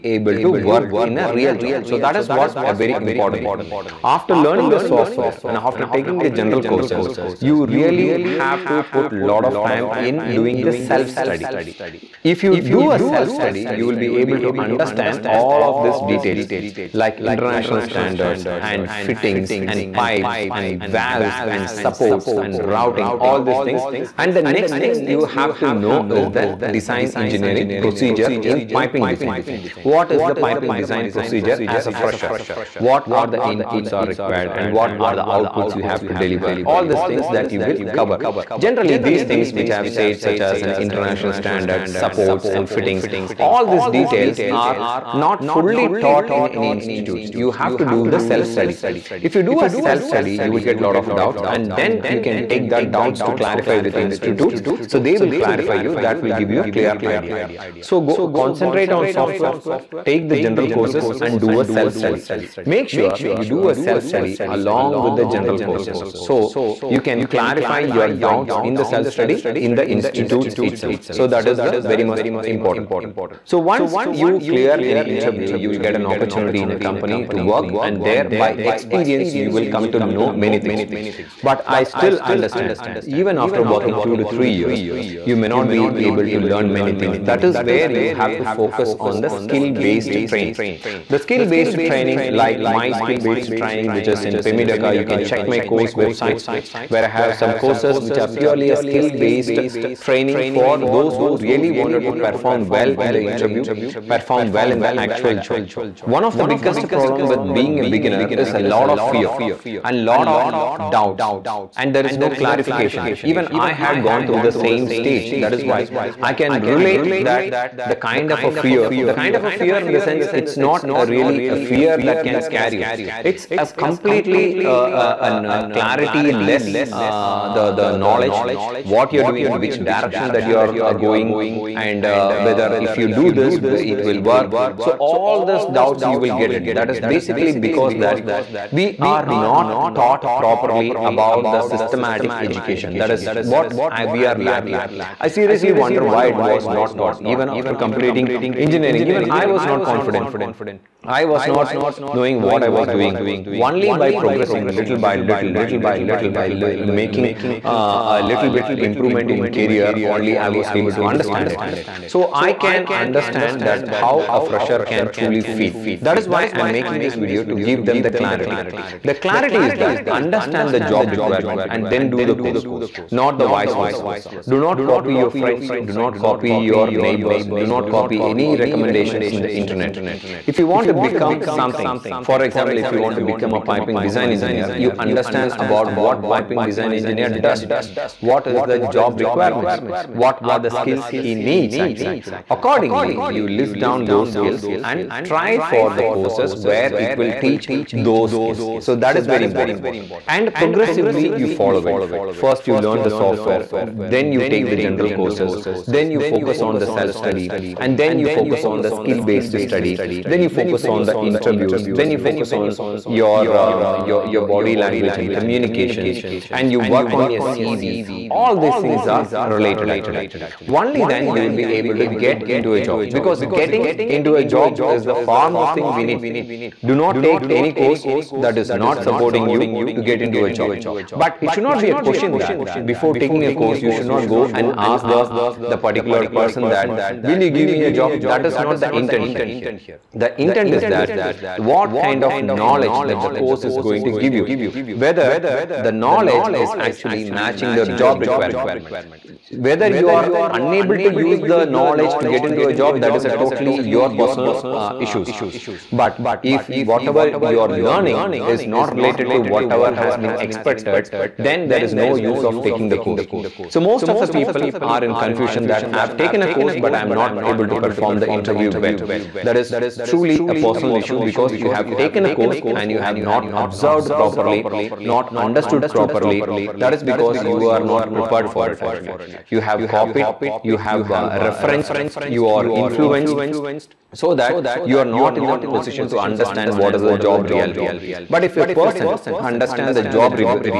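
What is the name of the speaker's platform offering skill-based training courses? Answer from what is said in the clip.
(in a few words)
Pymedaca.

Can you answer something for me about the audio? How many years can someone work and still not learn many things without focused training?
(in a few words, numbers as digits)
2 to 3 years.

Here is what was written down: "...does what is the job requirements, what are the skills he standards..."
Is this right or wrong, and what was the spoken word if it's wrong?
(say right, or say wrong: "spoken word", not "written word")
wrong: "needs", not "standards".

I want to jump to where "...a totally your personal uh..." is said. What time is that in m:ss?
4:13.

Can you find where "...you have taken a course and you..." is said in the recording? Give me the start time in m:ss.
4:31.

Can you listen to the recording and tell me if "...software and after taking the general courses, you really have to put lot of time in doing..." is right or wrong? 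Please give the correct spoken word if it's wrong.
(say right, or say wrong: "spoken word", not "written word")
right.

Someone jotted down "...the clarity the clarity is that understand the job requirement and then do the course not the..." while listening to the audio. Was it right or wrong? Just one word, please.
right.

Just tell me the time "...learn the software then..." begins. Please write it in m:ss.
3:22.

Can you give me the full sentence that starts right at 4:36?
That is because you are not prepared for it actually.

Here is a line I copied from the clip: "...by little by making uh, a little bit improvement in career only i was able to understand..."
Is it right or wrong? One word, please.
right.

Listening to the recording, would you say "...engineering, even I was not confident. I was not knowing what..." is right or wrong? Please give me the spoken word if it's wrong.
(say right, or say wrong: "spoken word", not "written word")
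right.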